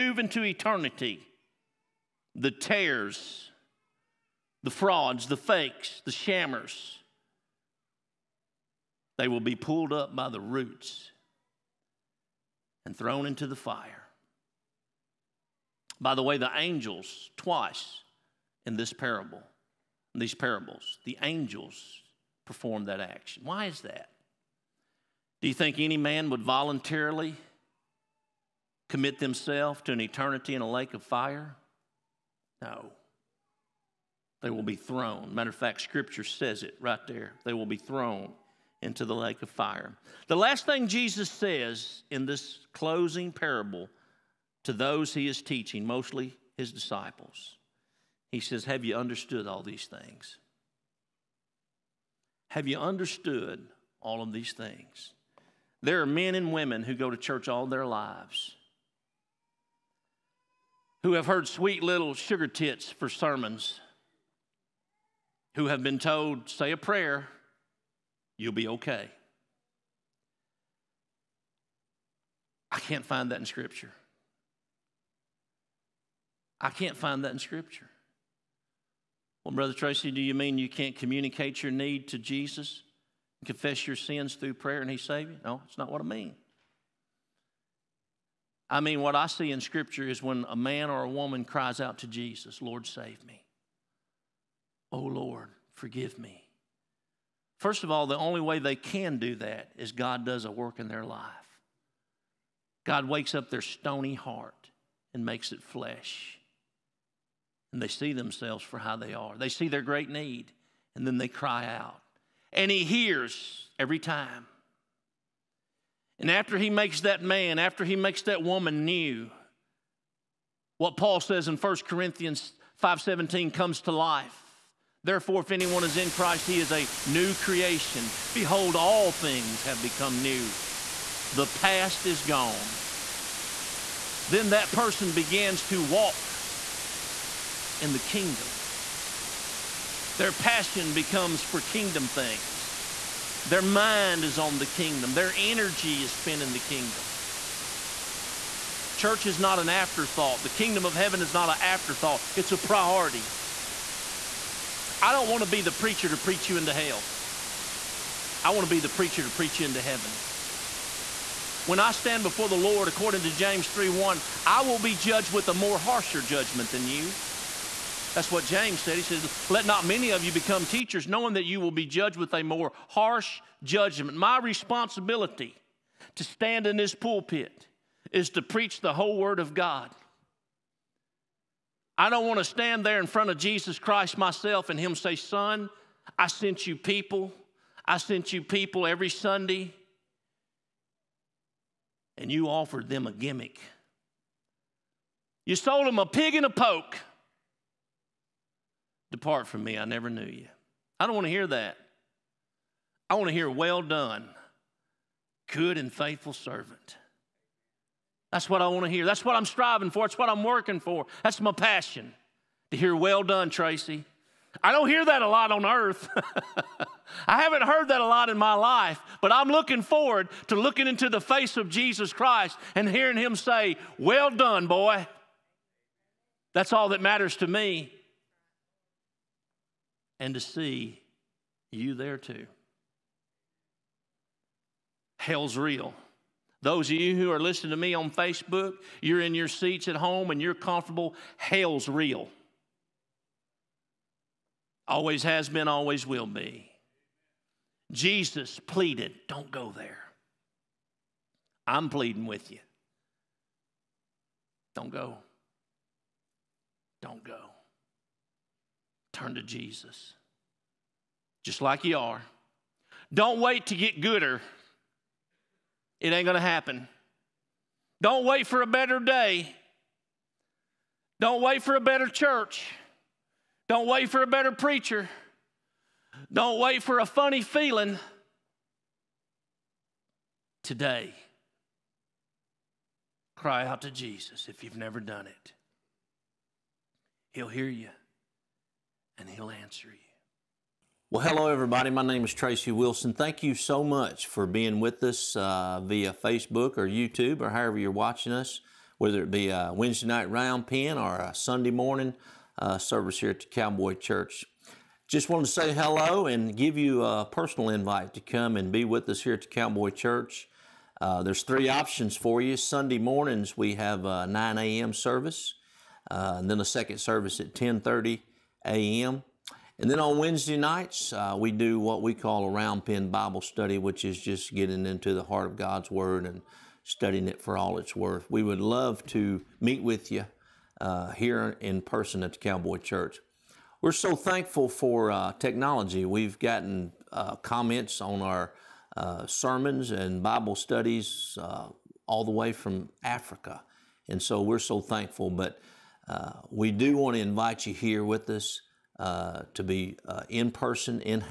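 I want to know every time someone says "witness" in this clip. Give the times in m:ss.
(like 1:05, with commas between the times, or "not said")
not said.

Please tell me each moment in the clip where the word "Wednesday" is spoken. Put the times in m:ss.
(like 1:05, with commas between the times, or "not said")
4:59, 5:20.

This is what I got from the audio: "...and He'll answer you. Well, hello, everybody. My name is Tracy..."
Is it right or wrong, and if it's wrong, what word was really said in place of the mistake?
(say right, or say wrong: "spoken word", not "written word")
right.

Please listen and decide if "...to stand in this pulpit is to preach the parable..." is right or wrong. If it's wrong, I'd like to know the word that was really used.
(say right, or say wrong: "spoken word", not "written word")
wrong: "whole", not "parable".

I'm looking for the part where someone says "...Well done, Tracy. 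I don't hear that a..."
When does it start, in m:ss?
3:32.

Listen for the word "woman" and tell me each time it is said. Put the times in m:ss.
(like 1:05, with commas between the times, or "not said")
1:31, 1:58.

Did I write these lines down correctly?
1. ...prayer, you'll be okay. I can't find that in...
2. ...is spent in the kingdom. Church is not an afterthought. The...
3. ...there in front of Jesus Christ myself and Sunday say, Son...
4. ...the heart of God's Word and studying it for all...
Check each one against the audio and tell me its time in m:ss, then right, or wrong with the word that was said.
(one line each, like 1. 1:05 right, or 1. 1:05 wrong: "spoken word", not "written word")
1. 1:06 right
2. 2:26 right
3. 3:02 wrong: "Him", not "Sunday"
4. 5:25 right.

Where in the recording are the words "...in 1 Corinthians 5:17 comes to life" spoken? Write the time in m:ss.
2:01.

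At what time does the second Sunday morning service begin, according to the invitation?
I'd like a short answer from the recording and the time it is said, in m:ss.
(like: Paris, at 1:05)
10:30 a.m., at 5:17.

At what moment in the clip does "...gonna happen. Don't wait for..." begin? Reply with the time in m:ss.
4:26.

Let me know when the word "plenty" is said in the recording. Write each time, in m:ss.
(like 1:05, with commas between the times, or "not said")
not said.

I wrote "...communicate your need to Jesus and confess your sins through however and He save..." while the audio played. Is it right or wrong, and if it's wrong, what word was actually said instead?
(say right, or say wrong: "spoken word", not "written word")
wrong: "prayer", not "however".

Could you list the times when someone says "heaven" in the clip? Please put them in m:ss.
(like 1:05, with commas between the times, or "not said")
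2:30, 2:39.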